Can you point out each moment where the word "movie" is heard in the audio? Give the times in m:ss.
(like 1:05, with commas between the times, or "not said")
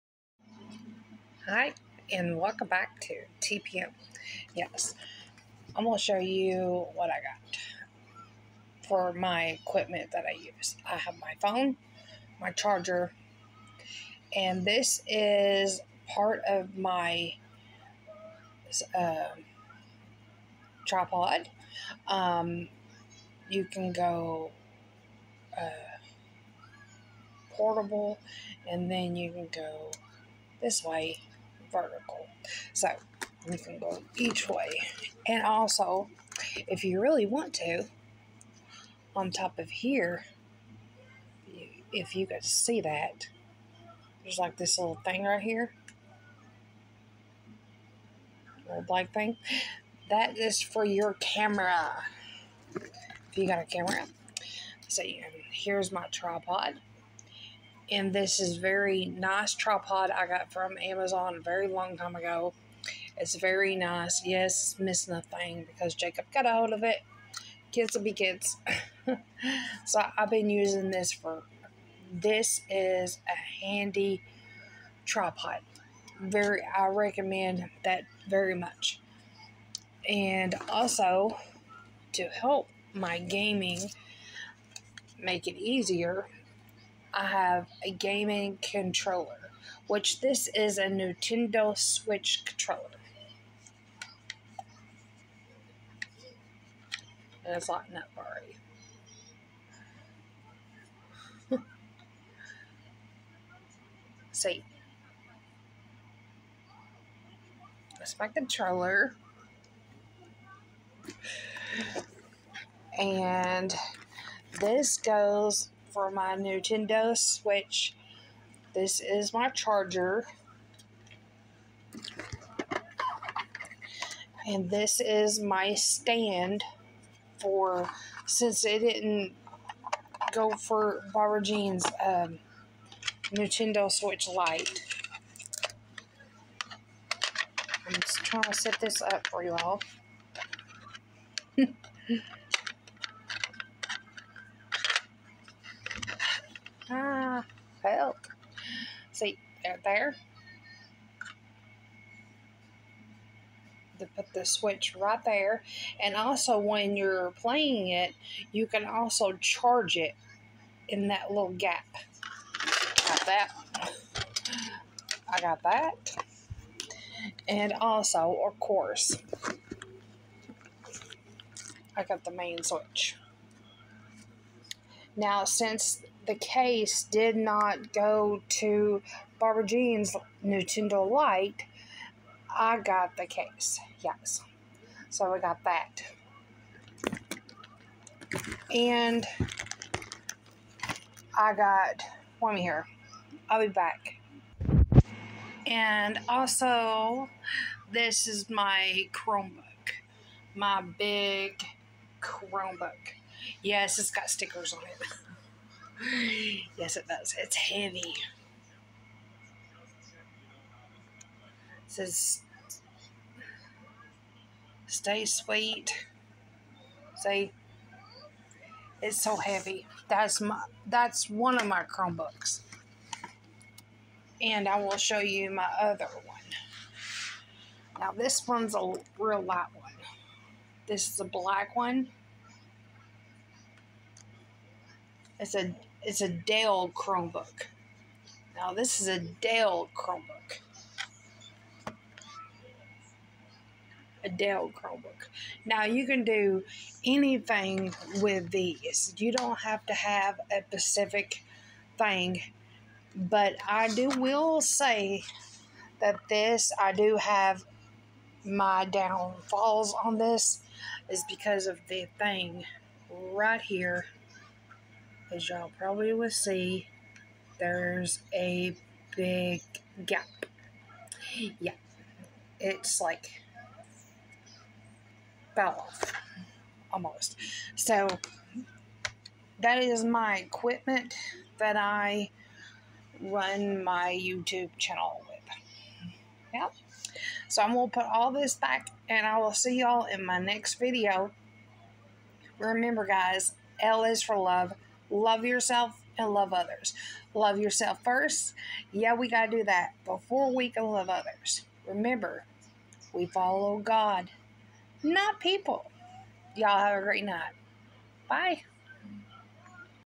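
not said.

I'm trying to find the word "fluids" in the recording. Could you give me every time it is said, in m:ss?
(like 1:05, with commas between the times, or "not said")
not said.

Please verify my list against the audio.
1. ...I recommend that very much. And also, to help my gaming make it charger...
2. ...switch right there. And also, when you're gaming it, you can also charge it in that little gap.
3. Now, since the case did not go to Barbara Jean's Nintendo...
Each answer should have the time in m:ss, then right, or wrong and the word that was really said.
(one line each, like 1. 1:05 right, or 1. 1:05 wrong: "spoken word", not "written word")
1. 1:16 wrong: "easier", not "charger"
2. 2:34 wrong: "playing", not "gaming"
3. 2:55 right.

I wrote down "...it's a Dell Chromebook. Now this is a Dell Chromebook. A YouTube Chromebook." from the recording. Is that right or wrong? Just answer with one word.
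wrong.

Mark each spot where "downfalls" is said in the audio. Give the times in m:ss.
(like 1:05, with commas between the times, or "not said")
4:18.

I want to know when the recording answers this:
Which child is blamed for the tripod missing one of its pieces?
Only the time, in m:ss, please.
1:05.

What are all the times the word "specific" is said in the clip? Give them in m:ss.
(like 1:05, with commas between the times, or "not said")
4:10.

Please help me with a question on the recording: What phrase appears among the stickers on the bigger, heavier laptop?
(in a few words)
Stay sweet.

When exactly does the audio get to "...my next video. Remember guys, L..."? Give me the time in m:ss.
4:50.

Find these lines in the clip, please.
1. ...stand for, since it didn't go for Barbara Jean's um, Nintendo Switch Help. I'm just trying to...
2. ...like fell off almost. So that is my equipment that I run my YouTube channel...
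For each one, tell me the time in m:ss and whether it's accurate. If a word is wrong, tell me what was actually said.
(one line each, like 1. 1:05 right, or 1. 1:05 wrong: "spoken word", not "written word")
1. 2:05 wrong: "Lite", not "Help"
2. 4:32 right.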